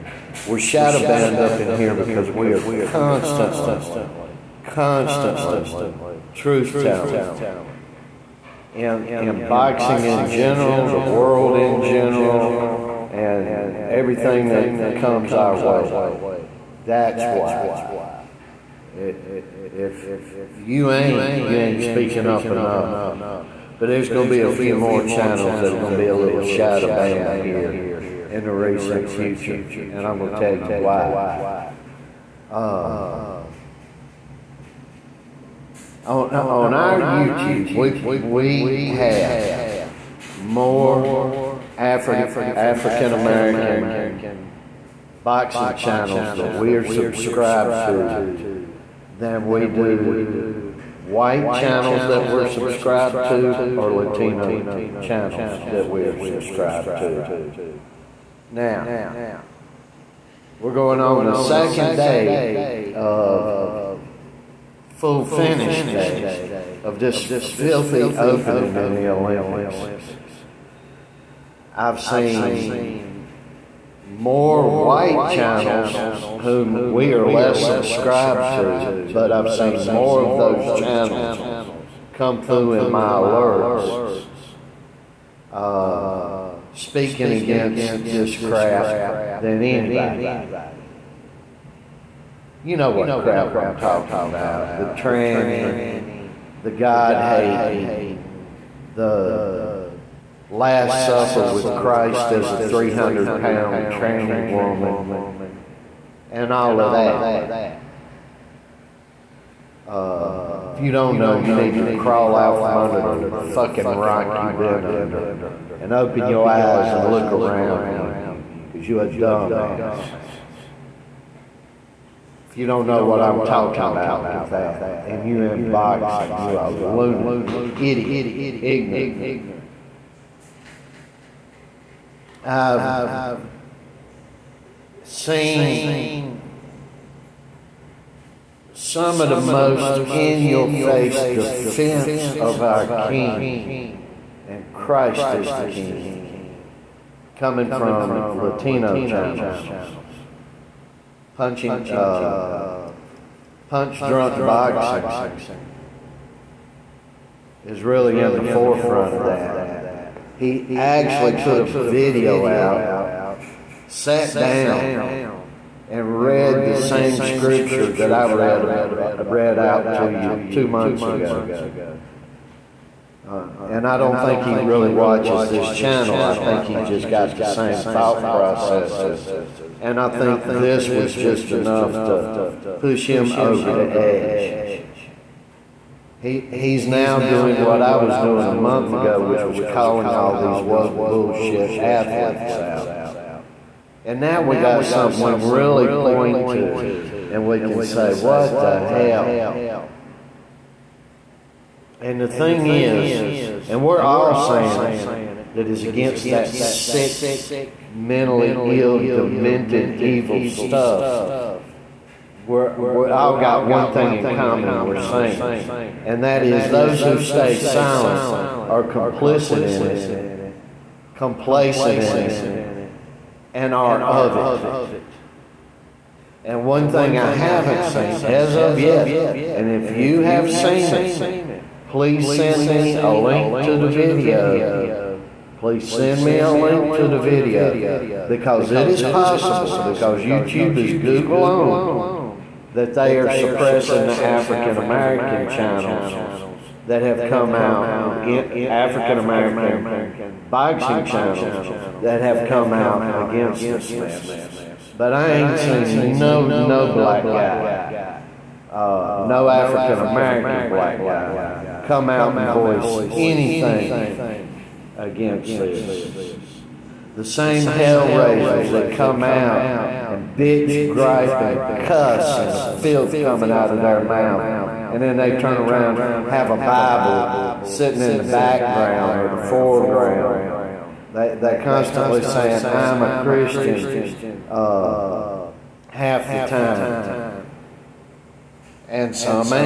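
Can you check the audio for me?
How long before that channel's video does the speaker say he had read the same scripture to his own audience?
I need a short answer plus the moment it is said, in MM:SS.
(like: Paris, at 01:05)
2 months ago, at 02:50.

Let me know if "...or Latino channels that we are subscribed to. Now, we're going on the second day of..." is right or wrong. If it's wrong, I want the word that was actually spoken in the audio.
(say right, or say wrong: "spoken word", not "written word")
right.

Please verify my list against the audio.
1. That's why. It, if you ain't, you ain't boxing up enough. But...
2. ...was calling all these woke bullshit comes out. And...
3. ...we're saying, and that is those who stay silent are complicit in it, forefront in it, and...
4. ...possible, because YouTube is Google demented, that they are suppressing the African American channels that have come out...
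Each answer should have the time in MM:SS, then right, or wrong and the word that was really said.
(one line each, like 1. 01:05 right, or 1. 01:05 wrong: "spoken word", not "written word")
1. 00:16 wrong: "speaking", not "boxing"
2. 03:09 wrong: "athletes", not "comes"
3. 03:34 wrong: "complacent", not "forefront"
4. 03:59 wrong: "owned", not "demented".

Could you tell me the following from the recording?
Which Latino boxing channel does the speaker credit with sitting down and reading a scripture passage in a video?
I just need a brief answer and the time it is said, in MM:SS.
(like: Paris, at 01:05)
Punch Drunk Boxing, at 02:33.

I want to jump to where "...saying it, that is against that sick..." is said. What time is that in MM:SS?
03:24.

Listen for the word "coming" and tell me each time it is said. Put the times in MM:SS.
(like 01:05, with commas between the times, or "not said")
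02:27, 04:33.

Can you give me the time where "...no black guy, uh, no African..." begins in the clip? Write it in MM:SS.
04:16.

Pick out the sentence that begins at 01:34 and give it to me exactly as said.
The tranny, the God hating, the Last Supper with Christ as a 300 pound tranny woman, and all of that.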